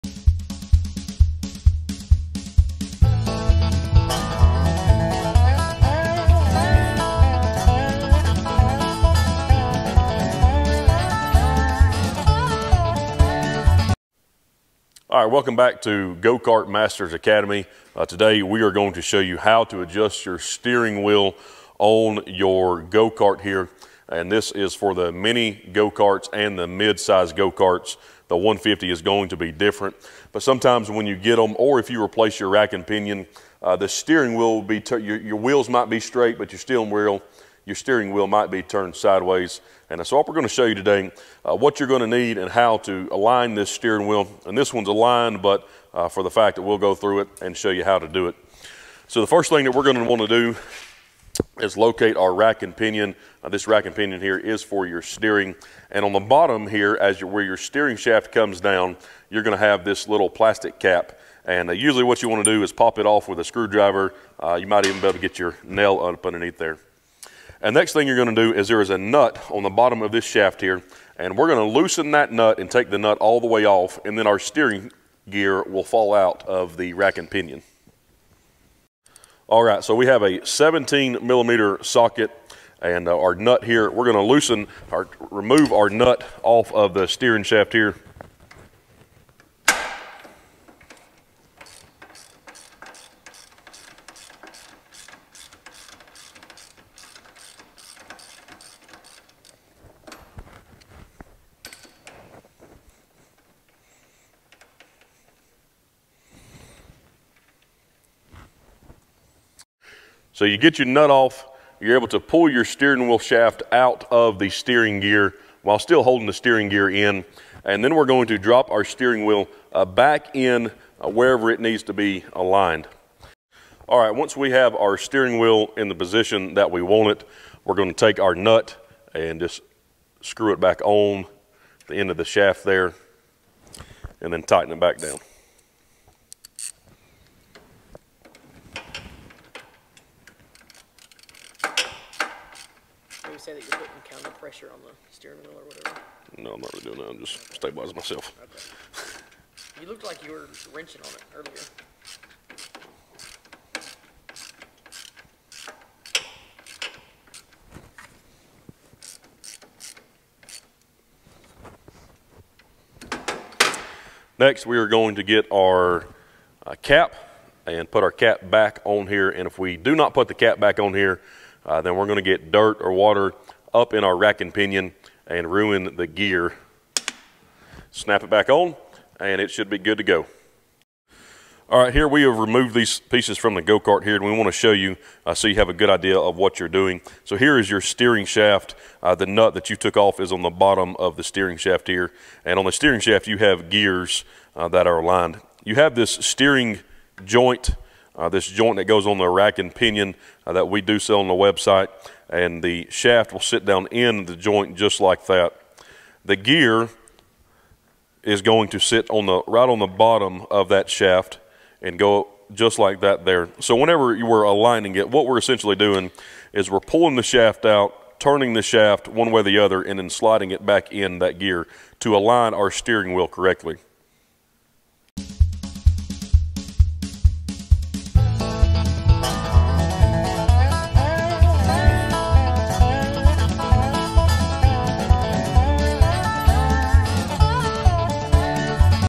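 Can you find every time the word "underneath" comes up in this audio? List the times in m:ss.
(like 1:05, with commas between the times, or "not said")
1:06.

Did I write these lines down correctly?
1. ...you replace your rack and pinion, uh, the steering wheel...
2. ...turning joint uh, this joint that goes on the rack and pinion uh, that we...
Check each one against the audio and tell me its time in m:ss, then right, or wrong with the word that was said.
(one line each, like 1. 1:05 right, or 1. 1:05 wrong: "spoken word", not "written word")
1. 0:31 right
2. 3:16 wrong: "steering", not "turning".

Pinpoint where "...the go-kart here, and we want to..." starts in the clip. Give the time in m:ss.
3:03.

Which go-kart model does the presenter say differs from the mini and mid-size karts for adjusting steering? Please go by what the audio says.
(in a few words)
150.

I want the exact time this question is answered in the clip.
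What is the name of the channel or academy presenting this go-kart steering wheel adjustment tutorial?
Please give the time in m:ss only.
0:16.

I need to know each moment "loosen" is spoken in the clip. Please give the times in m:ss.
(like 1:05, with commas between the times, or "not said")
1:11, 1:24.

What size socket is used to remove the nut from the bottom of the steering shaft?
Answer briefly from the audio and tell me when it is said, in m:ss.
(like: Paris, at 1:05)
17 millimeter, at 1:20.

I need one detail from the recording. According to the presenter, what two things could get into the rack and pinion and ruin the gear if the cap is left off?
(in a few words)
dirt or water.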